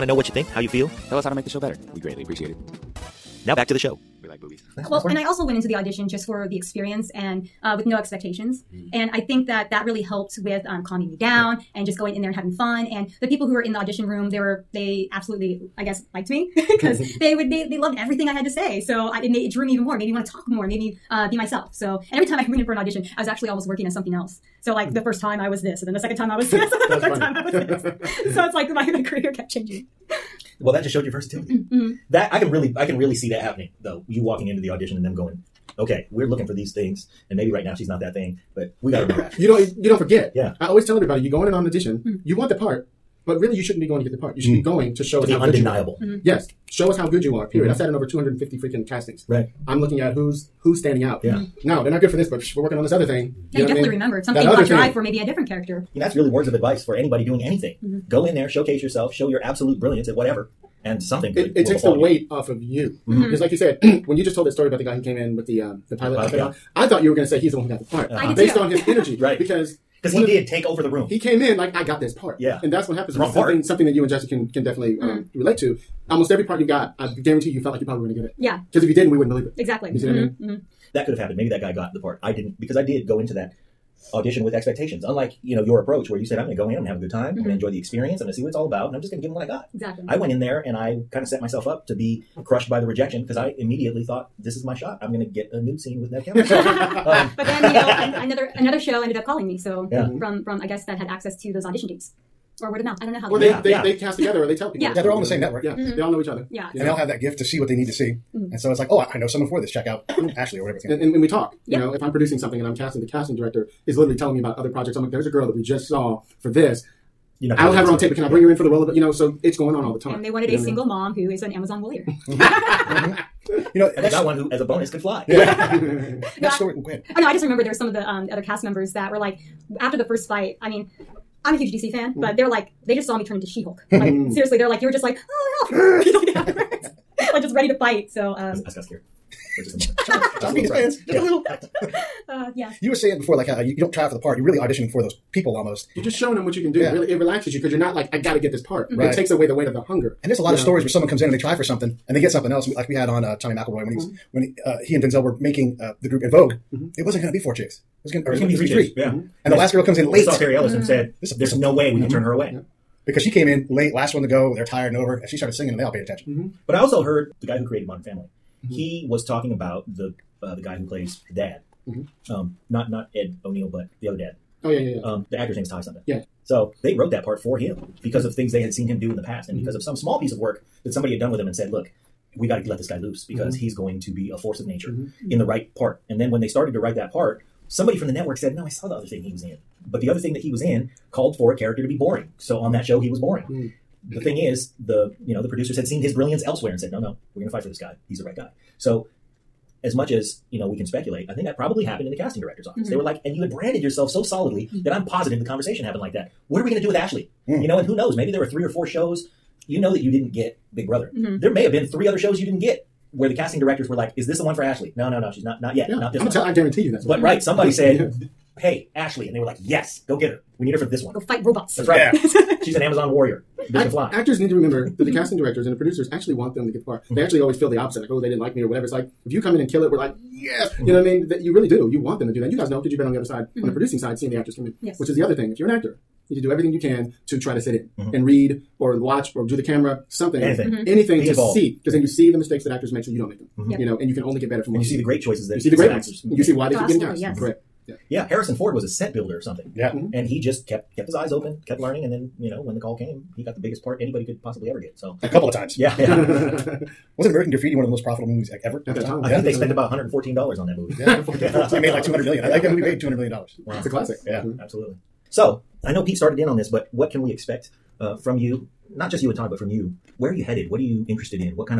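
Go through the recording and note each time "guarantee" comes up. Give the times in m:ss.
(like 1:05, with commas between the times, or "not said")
1:17, 3:36.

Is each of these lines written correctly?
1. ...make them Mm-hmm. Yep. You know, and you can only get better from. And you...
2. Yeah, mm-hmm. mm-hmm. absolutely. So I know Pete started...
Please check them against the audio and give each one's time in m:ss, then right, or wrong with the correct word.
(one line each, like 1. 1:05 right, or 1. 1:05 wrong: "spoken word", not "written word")
1. 4:03 right
2. 4:24 right.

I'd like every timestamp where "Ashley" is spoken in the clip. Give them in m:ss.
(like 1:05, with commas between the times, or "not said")
1:50, 3:26, 3:34, 3:38.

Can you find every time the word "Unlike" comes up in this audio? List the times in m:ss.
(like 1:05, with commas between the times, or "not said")
1:25.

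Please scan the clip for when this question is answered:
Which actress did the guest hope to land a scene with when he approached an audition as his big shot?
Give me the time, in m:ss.
1:36.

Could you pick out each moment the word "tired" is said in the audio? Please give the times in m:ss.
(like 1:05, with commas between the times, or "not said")
2:44.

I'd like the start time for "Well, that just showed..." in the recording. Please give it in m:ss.
0:30.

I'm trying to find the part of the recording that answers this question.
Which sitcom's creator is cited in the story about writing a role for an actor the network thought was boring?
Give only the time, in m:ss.
2:47.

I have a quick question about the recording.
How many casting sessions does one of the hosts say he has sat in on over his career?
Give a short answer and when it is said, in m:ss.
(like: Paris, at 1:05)
over 250, at 0:47.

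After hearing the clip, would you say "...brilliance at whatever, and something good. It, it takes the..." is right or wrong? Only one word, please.
right.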